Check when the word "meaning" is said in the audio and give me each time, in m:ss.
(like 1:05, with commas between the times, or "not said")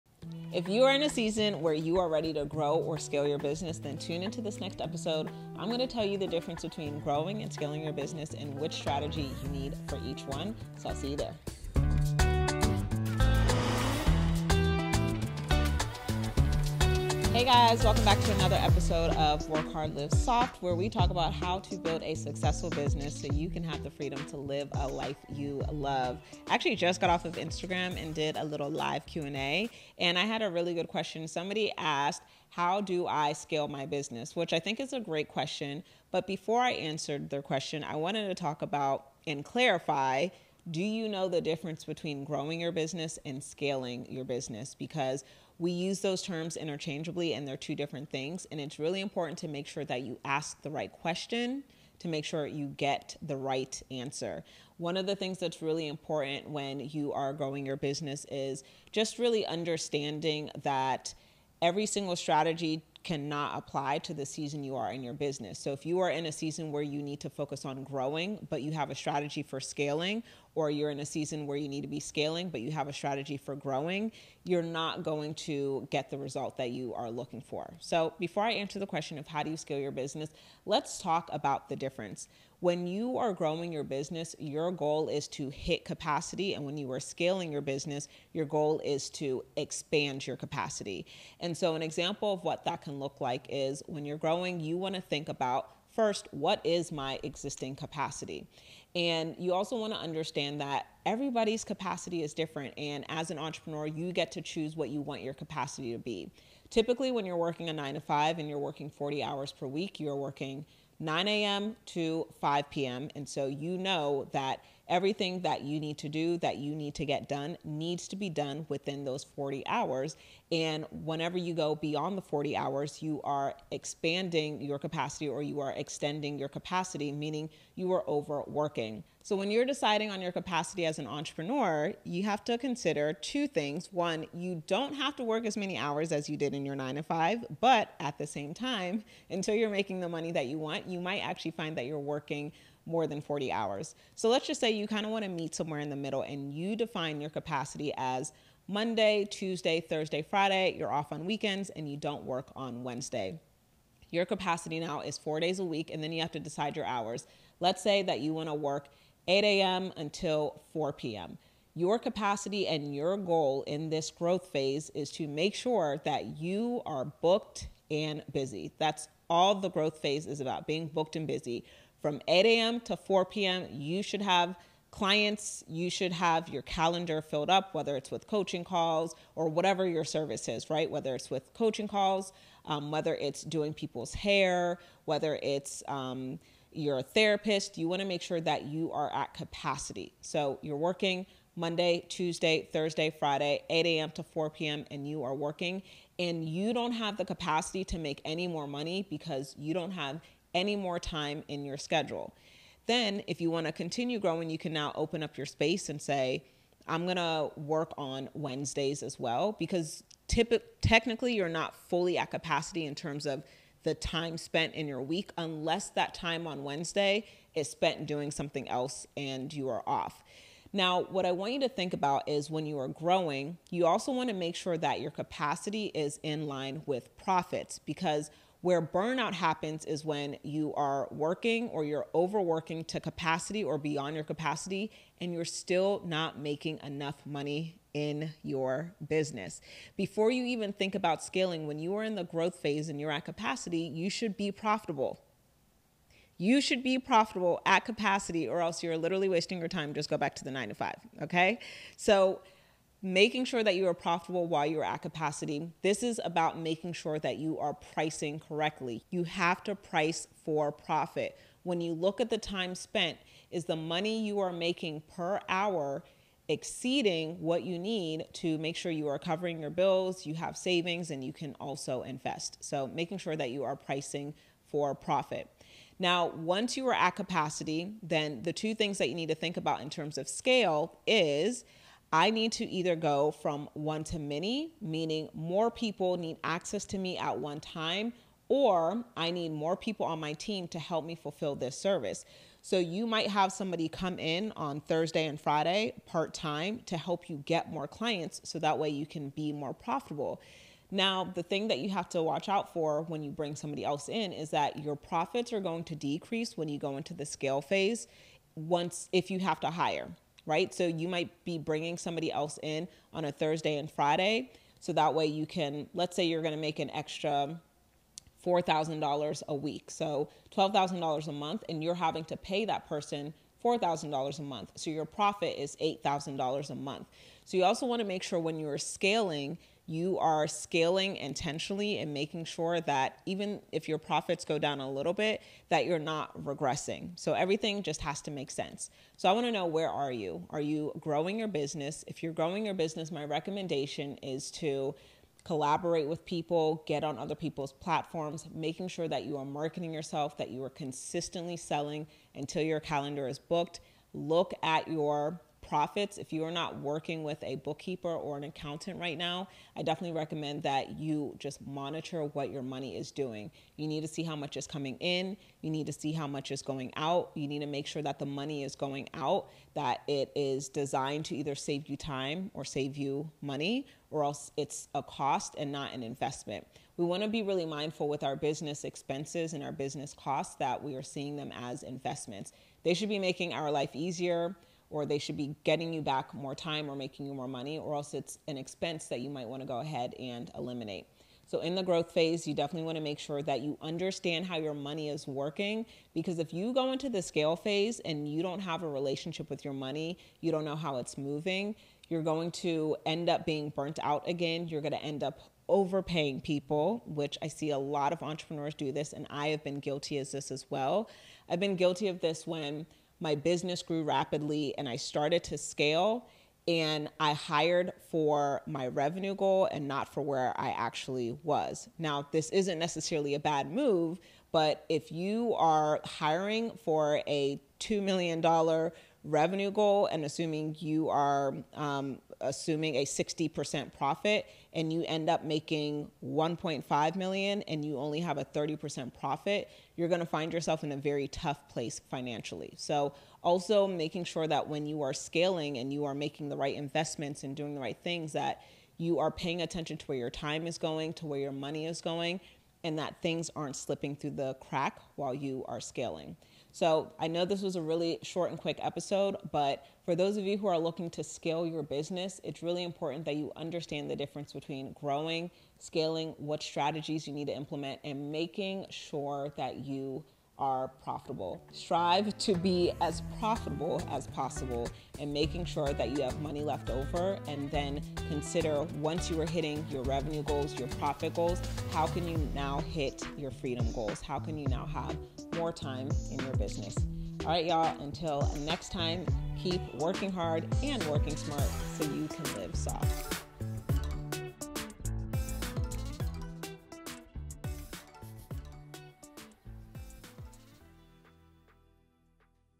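2:07, 4:44.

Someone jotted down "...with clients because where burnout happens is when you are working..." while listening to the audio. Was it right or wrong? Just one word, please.
wrong.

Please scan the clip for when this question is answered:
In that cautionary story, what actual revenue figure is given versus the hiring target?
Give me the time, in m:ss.
7:16.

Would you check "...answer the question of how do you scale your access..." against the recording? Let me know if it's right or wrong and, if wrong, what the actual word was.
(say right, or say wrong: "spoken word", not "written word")
wrong: "business", not "access".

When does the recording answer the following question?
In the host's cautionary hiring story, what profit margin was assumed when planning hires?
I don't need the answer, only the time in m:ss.
7:13.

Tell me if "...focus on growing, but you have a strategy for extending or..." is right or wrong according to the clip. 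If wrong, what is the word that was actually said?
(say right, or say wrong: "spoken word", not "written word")
wrong: "scaling", not "extending".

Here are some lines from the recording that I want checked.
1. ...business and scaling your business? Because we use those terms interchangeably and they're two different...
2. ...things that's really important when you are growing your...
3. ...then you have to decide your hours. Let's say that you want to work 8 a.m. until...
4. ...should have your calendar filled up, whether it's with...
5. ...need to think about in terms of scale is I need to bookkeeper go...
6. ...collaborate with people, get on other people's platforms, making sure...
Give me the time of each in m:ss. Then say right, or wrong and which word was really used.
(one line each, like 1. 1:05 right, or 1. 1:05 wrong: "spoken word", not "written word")
1. 0:42 right
2. 0:55 right
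3. 2:36 right
4. 2:55 right
5. 4:39 wrong: "either", not "bookkeeper"
6. 5:45 right.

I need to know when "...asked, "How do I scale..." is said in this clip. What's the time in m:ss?
0:31.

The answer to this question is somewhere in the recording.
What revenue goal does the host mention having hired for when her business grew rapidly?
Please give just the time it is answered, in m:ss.
7:07.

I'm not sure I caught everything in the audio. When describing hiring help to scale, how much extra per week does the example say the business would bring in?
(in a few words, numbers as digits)
$4,000.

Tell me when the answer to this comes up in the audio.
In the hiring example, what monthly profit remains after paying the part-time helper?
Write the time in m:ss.
5:25.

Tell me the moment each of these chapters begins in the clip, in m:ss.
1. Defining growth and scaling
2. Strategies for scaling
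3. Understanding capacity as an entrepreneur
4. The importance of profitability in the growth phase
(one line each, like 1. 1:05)
1. 1:15
2. 7:00
3. 3:00
4. 5:30.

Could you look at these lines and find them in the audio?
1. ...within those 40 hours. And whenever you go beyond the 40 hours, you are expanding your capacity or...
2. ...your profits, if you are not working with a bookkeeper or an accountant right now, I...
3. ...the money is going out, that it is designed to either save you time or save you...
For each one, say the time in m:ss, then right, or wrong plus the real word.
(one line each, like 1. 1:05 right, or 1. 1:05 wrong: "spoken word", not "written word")
1. 1:58 right
2. 5:54 right
3. 6:08 right.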